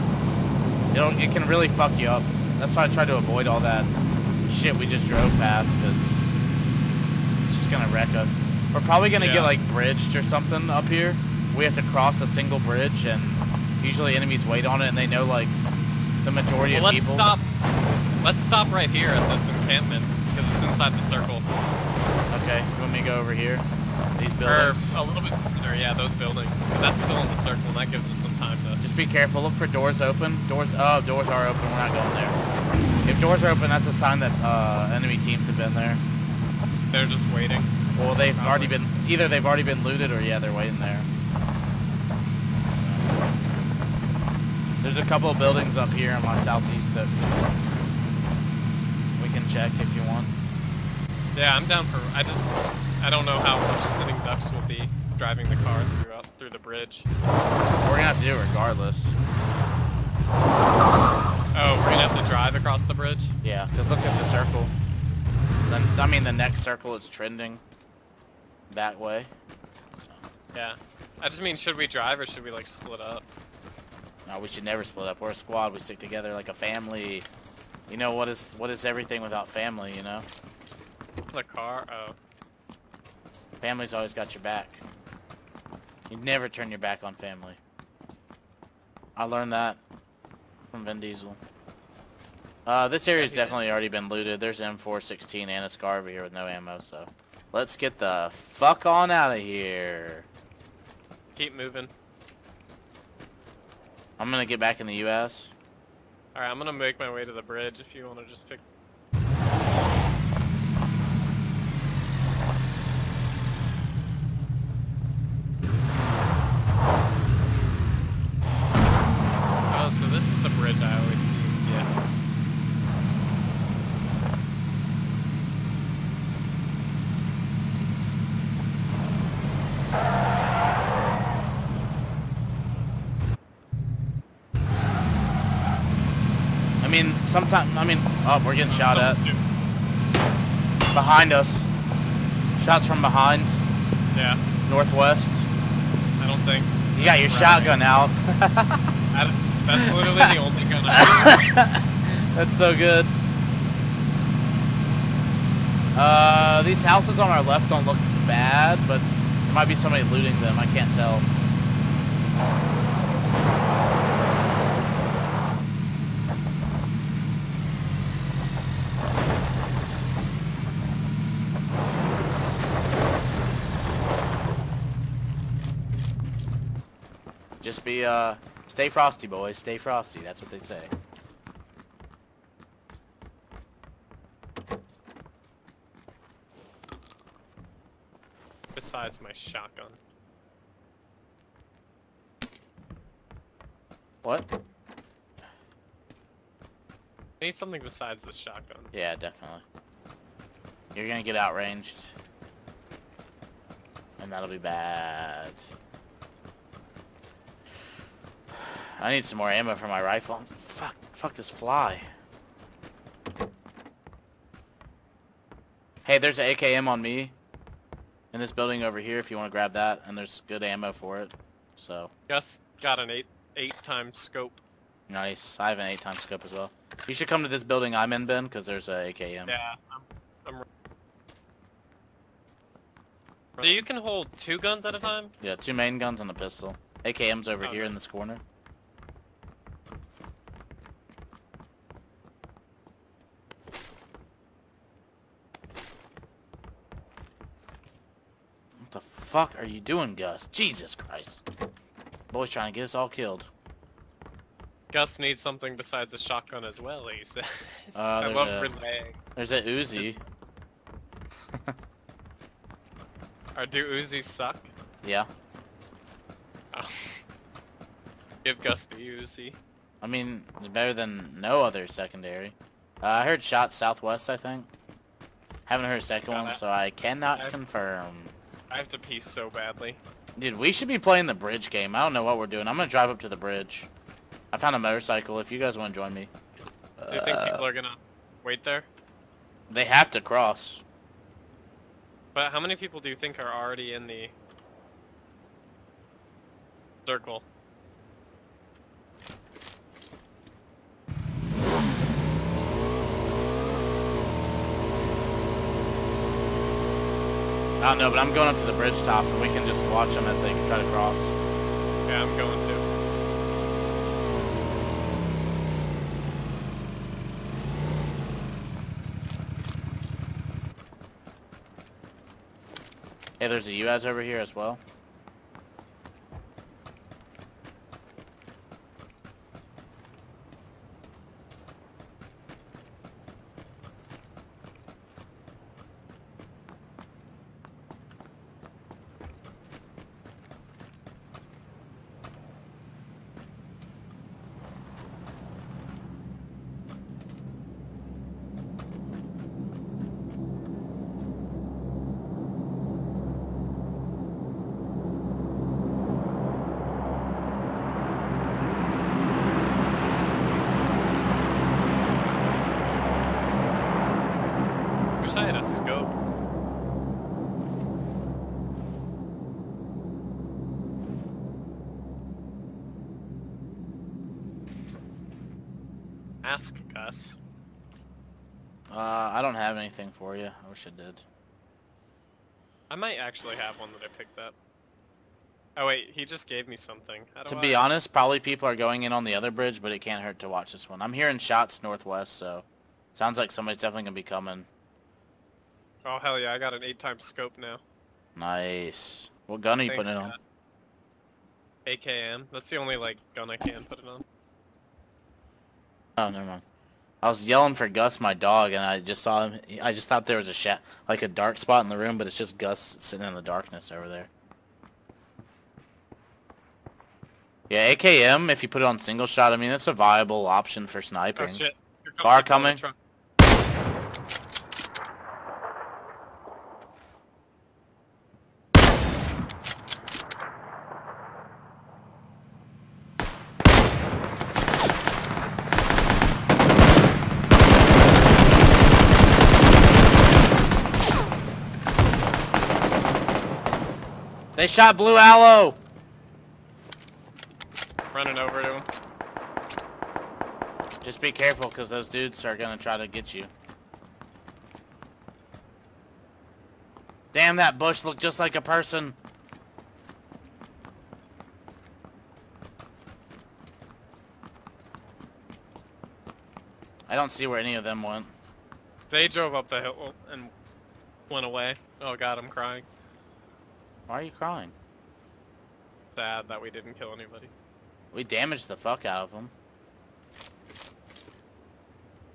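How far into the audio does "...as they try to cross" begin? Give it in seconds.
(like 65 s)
310 s.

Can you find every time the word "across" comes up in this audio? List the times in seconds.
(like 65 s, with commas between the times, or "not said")
62 s.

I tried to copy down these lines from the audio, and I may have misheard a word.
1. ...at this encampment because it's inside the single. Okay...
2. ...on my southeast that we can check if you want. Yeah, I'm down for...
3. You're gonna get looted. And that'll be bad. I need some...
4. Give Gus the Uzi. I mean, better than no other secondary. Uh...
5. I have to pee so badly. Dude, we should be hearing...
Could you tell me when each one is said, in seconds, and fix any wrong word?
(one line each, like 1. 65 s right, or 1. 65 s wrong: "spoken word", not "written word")
1. 19 s wrong: "circle", not "single"
2. 46 s right
3. 200 s wrong: "outranged", not "looted"
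4. 268 s right
5. 278 s wrong: "playing", not "hearing".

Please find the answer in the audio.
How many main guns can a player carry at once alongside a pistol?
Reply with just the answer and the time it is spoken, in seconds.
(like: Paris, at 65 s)
2, at 235 s.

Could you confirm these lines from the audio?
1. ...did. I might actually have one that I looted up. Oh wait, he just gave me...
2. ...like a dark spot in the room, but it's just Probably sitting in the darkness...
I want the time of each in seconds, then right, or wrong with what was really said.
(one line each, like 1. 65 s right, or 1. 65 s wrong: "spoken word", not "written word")
1. 380 s wrong: "picked", not "looted"
2. 411 s wrong: "Gus", not "Probably".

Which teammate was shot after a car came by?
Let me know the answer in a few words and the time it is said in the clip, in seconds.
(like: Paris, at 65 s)
Blue Aloe, at 444 s.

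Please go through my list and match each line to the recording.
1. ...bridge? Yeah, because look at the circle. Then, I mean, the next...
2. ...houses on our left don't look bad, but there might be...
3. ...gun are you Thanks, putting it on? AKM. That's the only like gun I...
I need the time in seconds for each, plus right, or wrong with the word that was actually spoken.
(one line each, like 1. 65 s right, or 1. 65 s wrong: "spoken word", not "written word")
1. 62 s right
2. 156 s right
3. 399 s right.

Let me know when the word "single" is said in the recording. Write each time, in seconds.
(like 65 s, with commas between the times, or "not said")
12 s, 418 s.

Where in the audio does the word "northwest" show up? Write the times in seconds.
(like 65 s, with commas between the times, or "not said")
144 s, 391 s.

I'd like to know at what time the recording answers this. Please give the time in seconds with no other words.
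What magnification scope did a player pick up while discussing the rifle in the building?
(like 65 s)
223 s.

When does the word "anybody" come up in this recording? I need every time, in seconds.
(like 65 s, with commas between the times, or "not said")
477 s.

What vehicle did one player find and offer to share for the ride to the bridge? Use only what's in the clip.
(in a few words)
Motorcycle.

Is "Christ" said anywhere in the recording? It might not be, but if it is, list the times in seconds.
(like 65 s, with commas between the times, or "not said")
250 s.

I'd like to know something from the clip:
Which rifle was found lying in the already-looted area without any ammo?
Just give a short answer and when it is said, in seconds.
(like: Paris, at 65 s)
M416, at 94 s.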